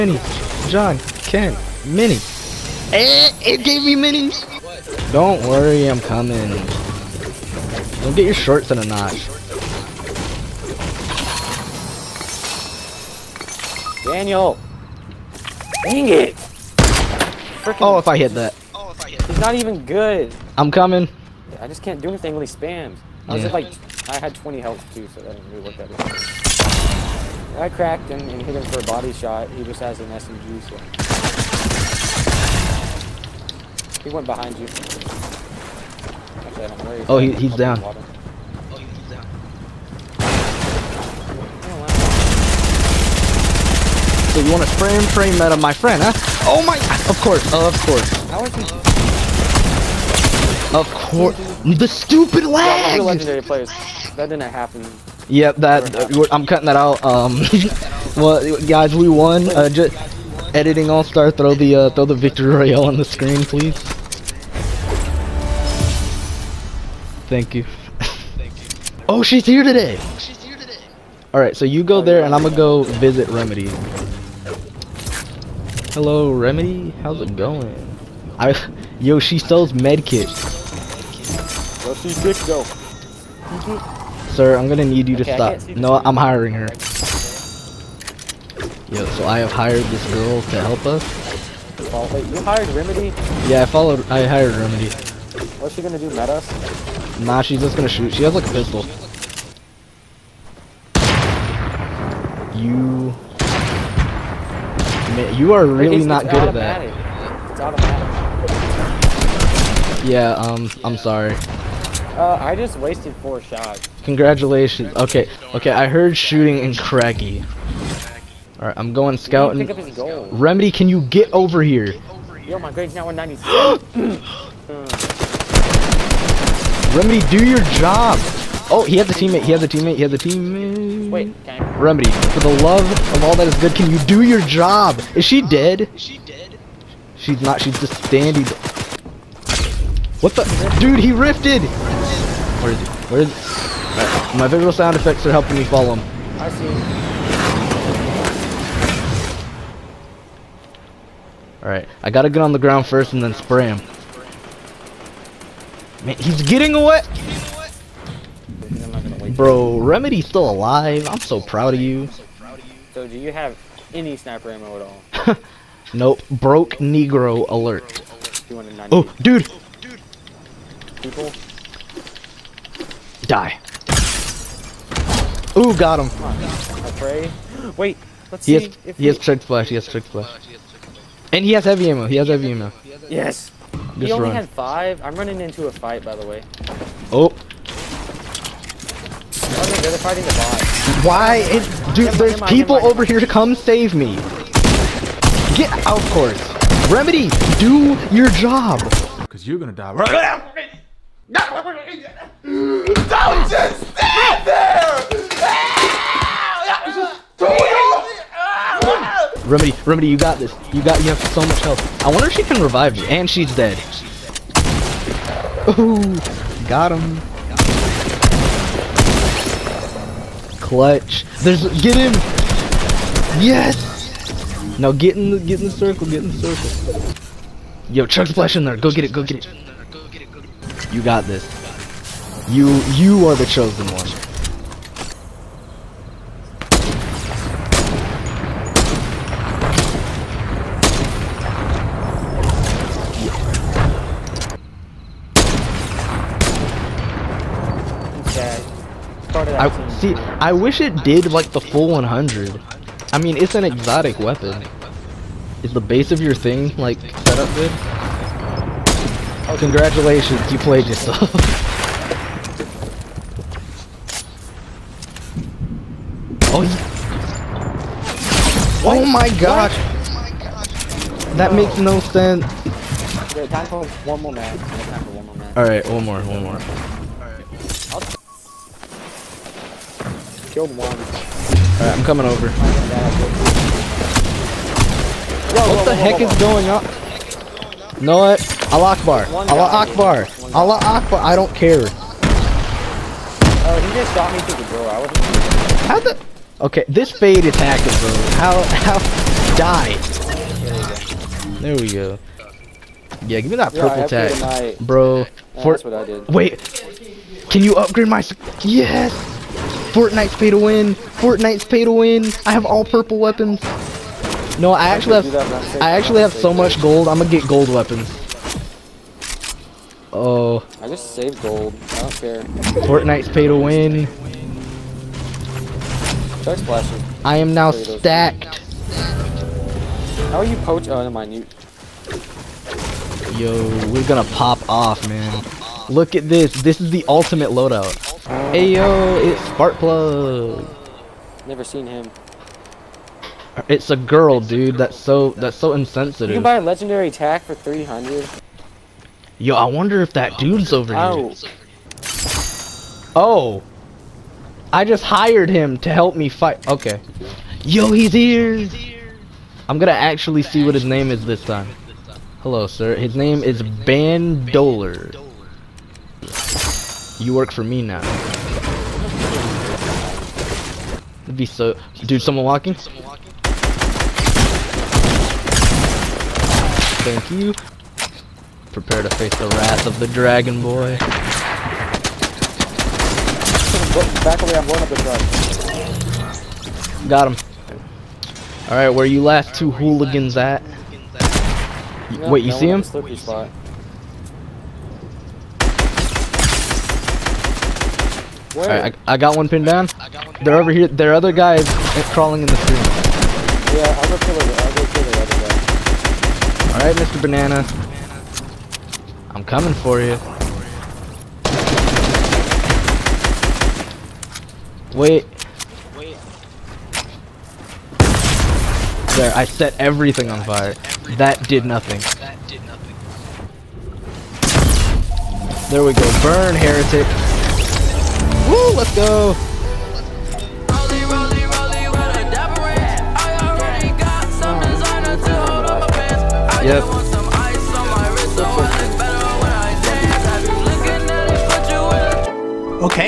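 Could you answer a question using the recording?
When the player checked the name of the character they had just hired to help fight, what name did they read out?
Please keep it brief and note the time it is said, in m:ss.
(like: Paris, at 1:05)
Ben, at 6:03.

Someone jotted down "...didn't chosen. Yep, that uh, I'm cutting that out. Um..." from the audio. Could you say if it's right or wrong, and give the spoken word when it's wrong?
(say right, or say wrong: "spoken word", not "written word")
wrong: "happen", not "chosen".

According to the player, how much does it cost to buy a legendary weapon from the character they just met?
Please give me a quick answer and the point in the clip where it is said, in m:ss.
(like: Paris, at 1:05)
300, at 5:47.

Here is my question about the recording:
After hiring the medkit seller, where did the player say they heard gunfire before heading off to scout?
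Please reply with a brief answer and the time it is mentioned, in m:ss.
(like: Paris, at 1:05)
Craggy, at 1:56.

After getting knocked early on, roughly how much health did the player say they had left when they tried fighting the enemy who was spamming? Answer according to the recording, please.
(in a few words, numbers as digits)
20.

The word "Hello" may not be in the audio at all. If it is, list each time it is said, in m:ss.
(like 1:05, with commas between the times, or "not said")
1:15, 6:02.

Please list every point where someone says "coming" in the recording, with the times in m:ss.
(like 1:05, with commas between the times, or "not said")
0:06, 0:20, 4:42, 6:49.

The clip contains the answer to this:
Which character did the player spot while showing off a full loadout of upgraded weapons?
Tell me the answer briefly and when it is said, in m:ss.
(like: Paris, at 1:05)
Sparkplug, at 5:39.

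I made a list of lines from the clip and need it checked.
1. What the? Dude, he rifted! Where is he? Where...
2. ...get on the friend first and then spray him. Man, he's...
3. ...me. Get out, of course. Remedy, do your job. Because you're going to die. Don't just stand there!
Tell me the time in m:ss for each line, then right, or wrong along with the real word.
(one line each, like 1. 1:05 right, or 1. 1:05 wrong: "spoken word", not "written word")
1. 2:20 right
2. 2:32 wrong: "ground", not "friend"
3. 3:13 right.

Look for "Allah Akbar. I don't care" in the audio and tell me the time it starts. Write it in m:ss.
4:50.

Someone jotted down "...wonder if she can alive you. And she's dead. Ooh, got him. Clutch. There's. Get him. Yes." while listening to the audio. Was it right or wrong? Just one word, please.
wrong.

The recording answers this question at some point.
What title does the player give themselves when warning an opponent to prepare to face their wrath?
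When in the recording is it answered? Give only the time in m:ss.
6:20.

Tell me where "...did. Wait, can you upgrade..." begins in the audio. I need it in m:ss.
5:06.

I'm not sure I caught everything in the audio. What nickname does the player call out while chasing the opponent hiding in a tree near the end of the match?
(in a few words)
Mr. Banana.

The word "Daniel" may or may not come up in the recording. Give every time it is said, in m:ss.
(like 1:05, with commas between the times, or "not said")
0:14.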